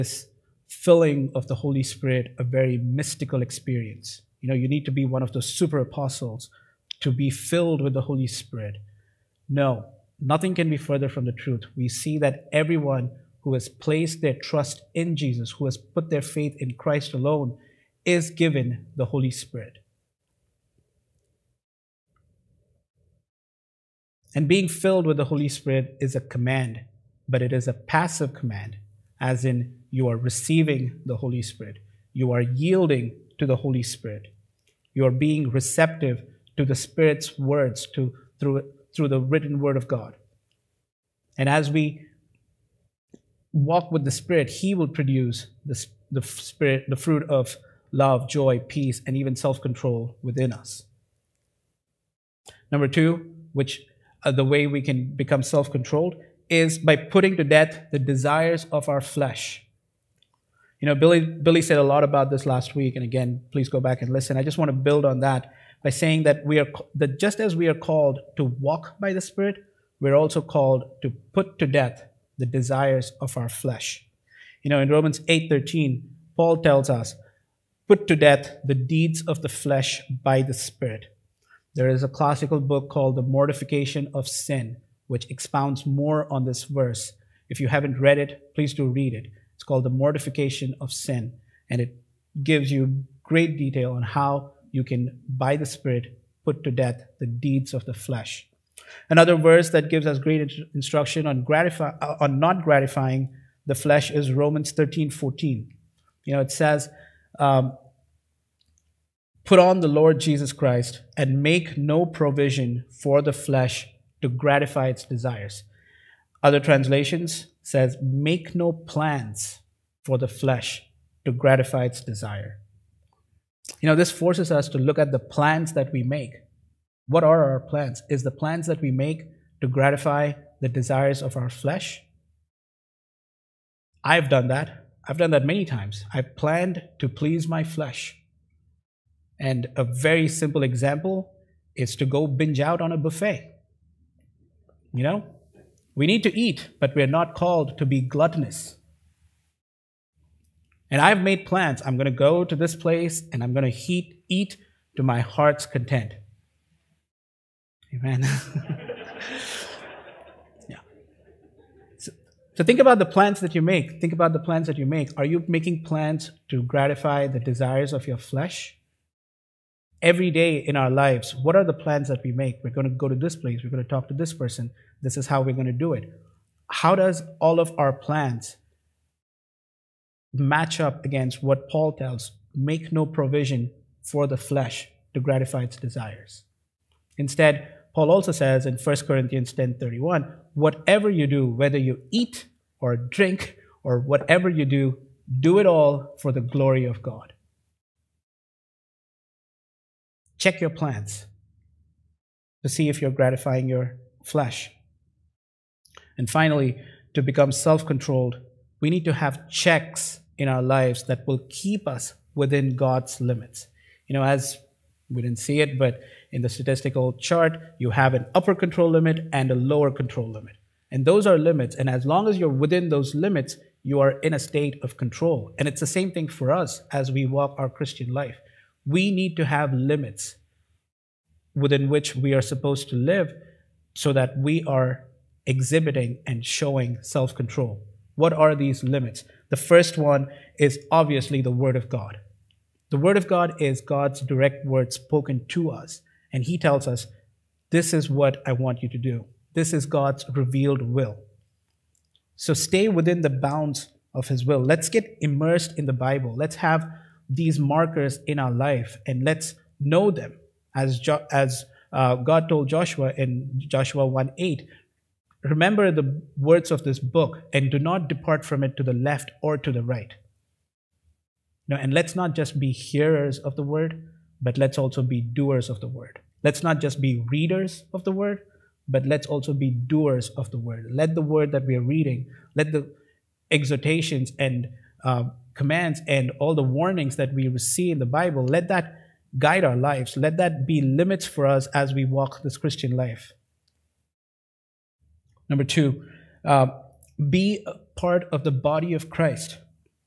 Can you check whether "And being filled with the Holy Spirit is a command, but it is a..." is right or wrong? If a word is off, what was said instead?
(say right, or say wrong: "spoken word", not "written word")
right.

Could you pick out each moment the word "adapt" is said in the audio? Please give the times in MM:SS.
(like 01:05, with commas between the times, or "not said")
not said.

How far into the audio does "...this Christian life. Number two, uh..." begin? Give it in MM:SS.
04:52.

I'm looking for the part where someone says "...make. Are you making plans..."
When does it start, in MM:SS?
02:44.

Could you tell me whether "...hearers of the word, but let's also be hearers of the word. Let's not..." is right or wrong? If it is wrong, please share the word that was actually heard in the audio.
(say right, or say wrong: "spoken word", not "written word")
wrong: "doers", not "hearers".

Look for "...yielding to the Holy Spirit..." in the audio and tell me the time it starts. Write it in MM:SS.
00:32.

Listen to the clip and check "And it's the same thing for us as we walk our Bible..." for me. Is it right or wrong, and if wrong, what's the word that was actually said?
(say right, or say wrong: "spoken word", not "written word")
wrong: "Christian", not "Bible".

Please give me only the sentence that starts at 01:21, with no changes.
There is a classical book called The Mortification of Sin which expounds more on this verse.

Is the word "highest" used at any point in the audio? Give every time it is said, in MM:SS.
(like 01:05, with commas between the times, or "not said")
not said.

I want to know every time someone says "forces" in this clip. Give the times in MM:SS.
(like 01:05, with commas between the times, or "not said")
02:04.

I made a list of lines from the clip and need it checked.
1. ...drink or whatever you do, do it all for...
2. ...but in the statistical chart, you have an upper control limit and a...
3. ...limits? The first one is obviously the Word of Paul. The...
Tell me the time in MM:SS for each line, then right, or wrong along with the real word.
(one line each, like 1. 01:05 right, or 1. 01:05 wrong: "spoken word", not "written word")
1. 03:12 right
2. 03:35 right
3. 03:58 wrong: "God", not "Paul".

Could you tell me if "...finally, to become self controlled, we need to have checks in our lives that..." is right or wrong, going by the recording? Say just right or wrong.
right.